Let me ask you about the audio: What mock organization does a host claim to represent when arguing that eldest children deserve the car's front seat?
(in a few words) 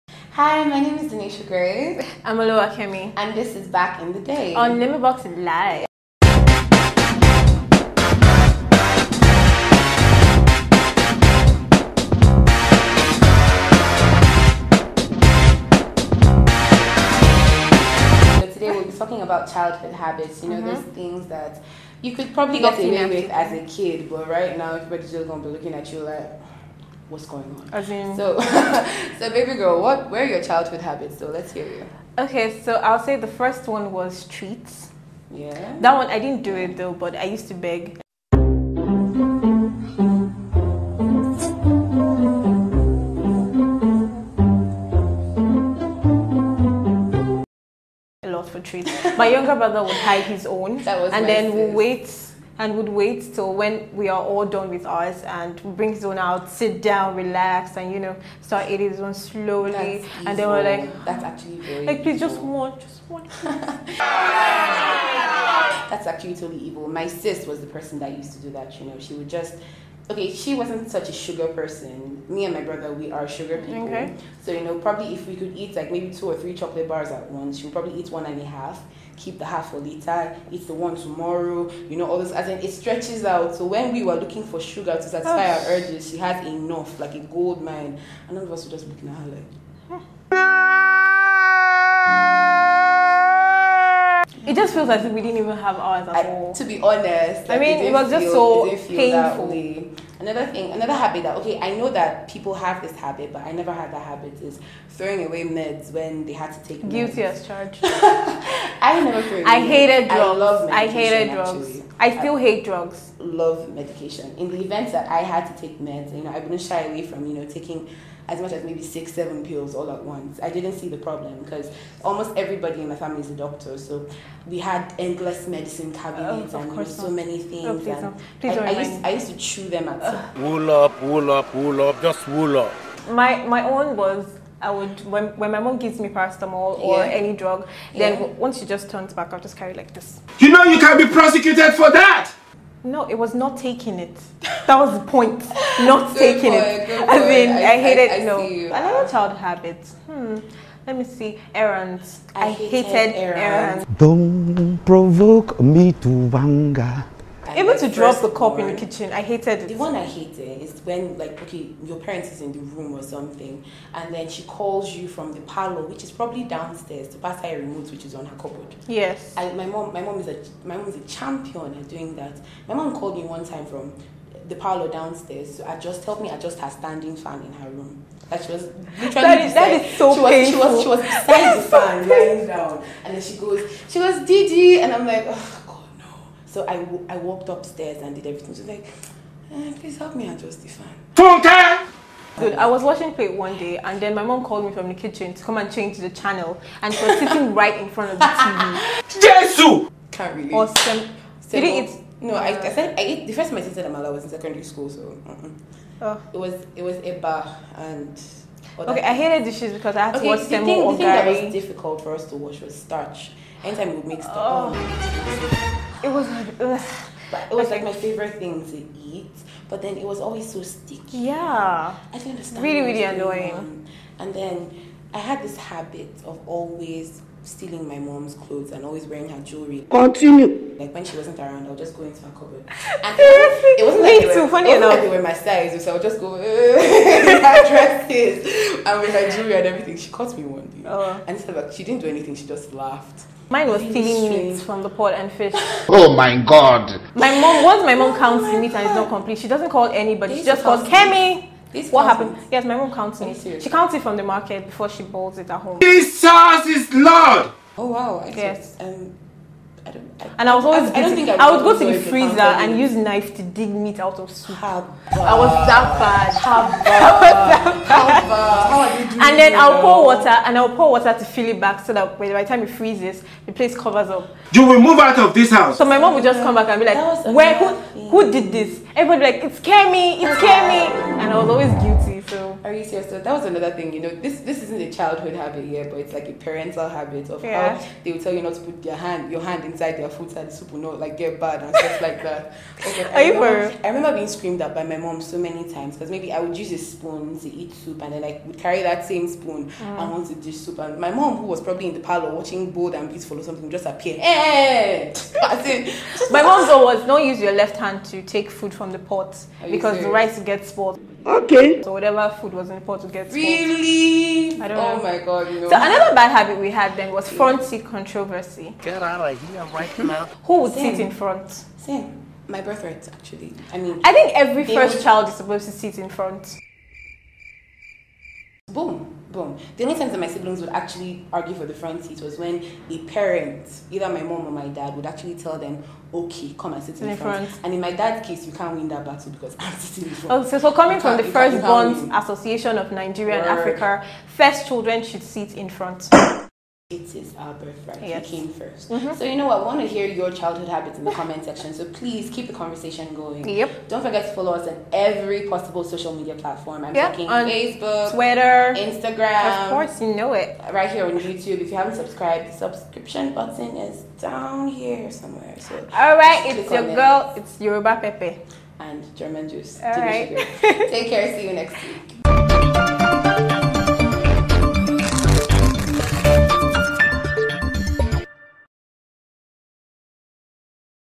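Firstborn Association of Nigeria and Africa.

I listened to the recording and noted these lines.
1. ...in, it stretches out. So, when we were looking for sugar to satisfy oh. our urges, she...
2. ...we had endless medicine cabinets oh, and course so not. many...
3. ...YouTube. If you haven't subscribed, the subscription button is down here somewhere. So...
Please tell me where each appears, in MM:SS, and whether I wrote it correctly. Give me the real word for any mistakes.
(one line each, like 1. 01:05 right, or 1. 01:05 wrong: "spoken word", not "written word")
1. 01:22 right
2. 02:04 right
3. 06:01 right.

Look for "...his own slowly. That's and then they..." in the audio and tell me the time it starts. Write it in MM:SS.
00:58.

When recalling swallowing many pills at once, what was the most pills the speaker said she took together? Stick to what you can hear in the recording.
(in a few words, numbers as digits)
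7.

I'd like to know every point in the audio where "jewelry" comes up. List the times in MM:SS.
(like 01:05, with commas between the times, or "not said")
03:49, 03:59.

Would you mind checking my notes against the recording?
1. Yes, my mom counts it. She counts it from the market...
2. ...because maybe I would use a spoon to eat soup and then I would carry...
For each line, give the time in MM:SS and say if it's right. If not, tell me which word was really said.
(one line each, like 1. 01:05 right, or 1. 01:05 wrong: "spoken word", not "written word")
1. 04:12 right
2. 04:55 right.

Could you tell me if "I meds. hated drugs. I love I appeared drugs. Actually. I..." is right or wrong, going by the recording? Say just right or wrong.
wrong.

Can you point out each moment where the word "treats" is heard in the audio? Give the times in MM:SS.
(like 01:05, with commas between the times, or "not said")
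00:34, 00:48.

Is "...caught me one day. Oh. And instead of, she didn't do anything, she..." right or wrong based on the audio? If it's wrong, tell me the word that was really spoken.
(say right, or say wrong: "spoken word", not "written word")
right.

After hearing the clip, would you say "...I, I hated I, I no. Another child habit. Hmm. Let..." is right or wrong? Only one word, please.
right.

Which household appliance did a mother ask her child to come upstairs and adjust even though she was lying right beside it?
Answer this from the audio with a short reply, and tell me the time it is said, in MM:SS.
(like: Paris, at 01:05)
Standing fan, at 02:56.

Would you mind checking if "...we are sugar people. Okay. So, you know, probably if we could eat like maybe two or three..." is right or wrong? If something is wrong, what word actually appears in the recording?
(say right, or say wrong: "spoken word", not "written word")
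right.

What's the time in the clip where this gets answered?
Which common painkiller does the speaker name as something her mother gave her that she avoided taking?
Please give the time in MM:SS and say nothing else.
02:16.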